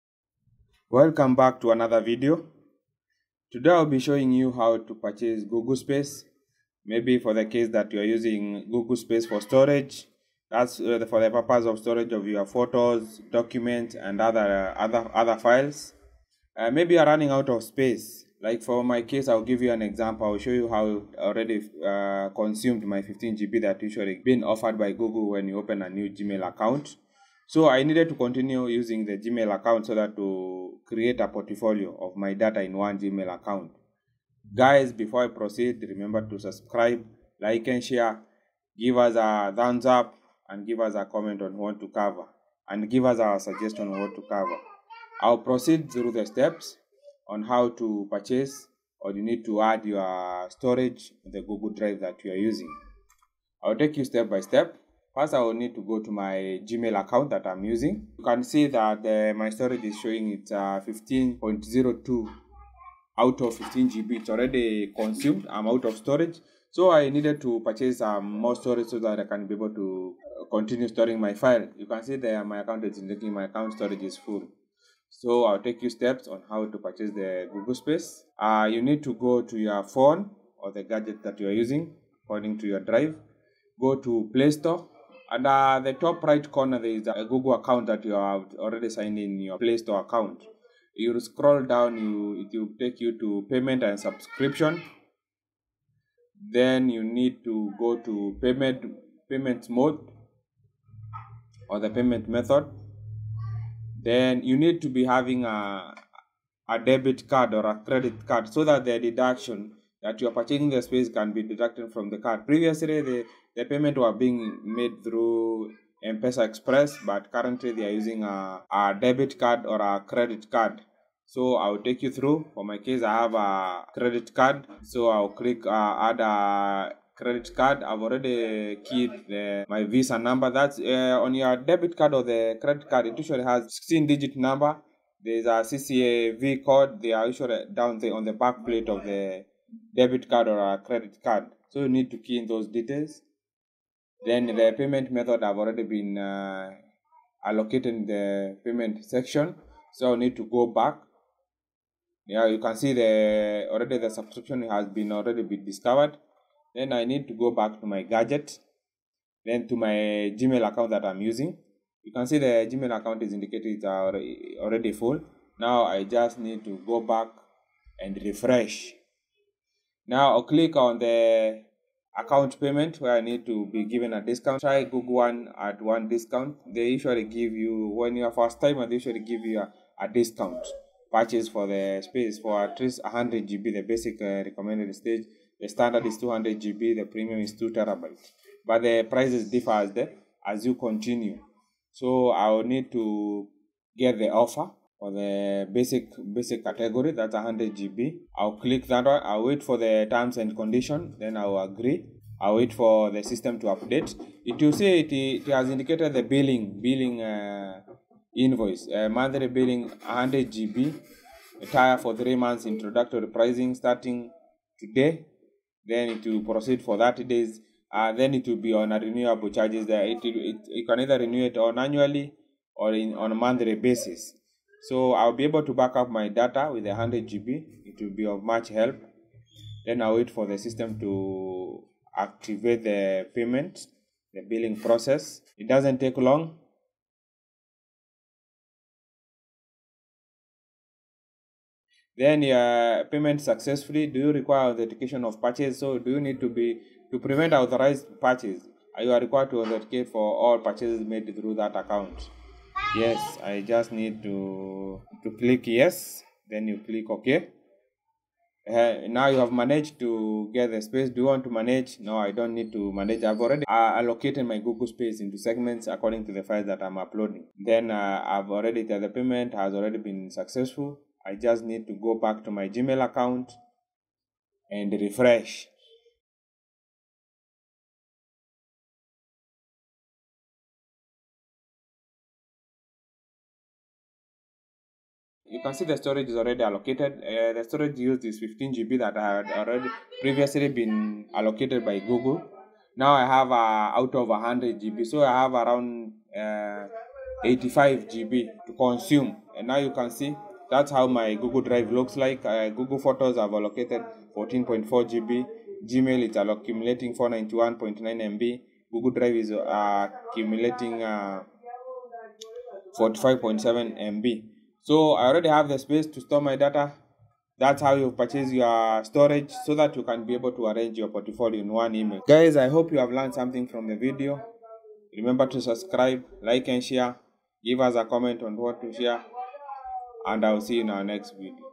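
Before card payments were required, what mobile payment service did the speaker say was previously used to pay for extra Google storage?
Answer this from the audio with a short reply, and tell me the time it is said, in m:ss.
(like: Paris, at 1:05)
M-Pesa Express, at 1:56.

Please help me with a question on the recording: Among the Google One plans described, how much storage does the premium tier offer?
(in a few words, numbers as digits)
2 terabytes.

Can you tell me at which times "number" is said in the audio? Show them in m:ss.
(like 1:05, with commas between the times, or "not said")
2:10, 2:14.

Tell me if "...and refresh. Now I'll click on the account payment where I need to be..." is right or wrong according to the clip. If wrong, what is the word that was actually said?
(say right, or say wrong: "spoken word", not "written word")
right.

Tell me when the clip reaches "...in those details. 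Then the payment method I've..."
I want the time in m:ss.
2:22.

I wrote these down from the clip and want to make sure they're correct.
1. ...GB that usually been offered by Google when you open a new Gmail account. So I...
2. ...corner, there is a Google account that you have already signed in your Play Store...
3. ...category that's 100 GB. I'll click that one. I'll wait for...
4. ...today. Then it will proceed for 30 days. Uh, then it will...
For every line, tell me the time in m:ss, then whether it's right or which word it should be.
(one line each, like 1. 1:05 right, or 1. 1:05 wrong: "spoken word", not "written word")
1. 0:23 right
2. 1:26 right
3. 3:16 right
4. 3:34 right.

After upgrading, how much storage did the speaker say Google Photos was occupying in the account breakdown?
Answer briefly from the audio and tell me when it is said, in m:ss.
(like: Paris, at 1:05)
14.4 GB, at 5:04.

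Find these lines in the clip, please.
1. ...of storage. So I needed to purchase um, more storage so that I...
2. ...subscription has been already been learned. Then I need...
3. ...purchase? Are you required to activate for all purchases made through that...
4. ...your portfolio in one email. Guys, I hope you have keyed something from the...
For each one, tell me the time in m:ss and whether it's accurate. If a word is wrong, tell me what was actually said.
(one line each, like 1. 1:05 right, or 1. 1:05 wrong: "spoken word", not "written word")
1. 1:05 right
2. 2:34 wrong: "discovered", not "learned"
3. 4:08 wrong: "authenticate", not "activate"
4. 5:20 wrong: "learned", not "keyed".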